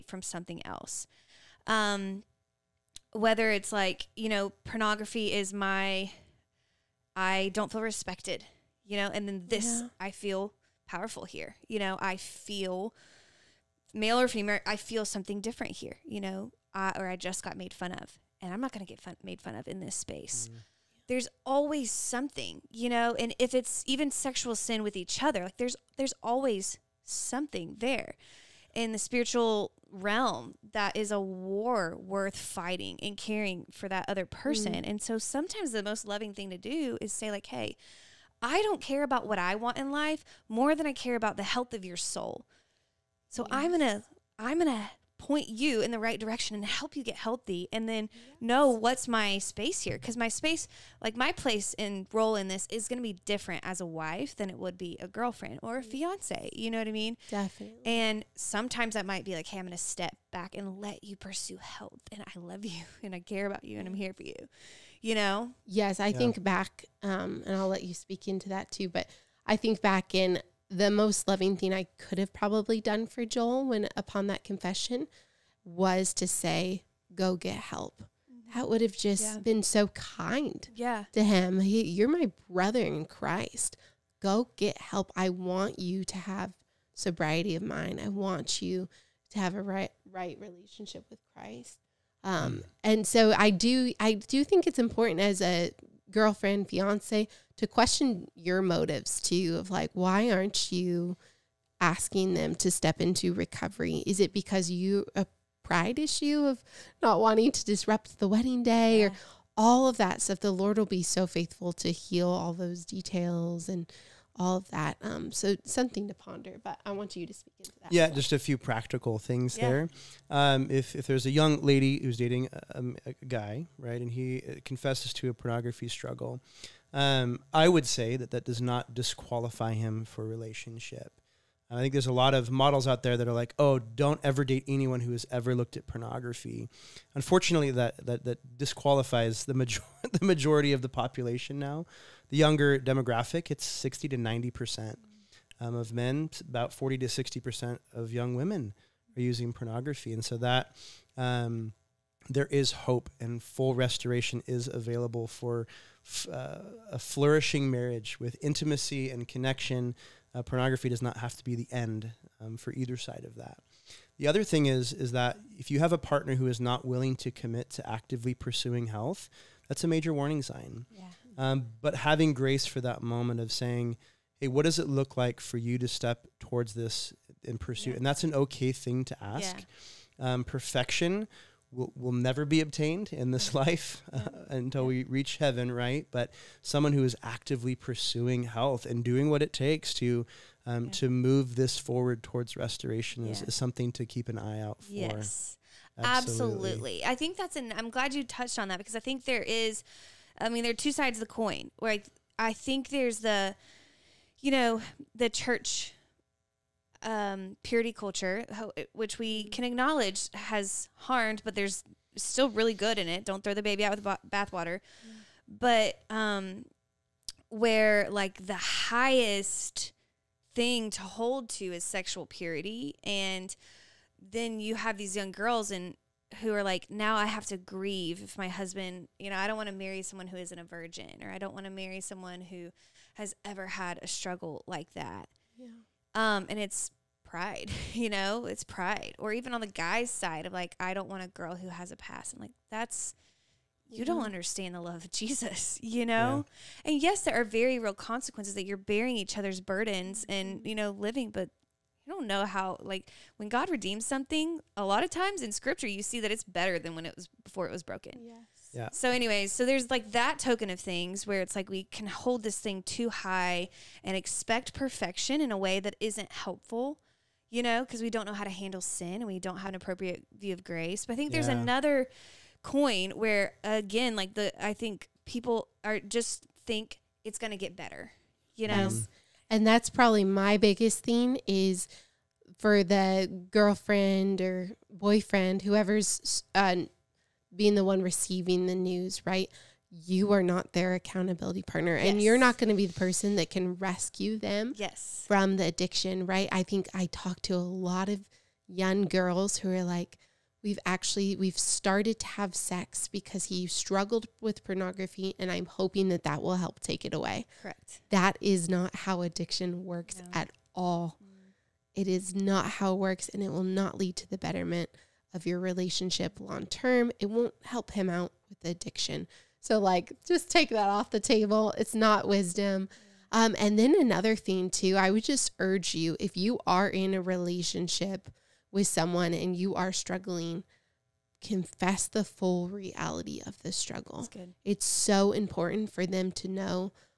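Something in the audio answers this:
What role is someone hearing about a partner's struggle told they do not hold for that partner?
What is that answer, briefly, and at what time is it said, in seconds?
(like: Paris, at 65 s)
Accountability partner, at 290 s.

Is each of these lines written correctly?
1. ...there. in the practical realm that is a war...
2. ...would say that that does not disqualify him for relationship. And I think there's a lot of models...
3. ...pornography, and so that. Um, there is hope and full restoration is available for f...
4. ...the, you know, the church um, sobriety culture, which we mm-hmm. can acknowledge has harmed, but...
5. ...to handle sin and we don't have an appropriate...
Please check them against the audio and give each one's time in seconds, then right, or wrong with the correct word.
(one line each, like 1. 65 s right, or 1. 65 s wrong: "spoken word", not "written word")
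1. 27 s wrong: "spiritual", not "practical"
2. 127 s right
3. 149 s right
4. 203 s wrong: "purity", not "sobriety"
5. 268 s right.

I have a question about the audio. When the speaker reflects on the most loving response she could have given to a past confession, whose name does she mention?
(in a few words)
Joel.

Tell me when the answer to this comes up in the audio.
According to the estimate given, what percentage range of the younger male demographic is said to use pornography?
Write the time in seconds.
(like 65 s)
143 s.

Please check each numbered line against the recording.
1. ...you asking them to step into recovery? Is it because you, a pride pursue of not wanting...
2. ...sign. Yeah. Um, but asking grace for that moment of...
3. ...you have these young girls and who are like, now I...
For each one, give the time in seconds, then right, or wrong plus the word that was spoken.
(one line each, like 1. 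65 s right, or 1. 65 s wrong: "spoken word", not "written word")
1. 100 s wrong: "issue", not "pursue"
2. 170 s wrong: "having", not "asking"
3. 224 s right.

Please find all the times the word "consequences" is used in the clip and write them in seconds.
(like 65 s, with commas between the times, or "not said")
247 s.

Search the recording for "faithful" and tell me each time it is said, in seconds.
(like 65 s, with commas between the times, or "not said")
111 s.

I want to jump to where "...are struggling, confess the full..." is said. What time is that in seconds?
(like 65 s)
329 s.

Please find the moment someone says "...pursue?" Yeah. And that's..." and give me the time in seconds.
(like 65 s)
177 s.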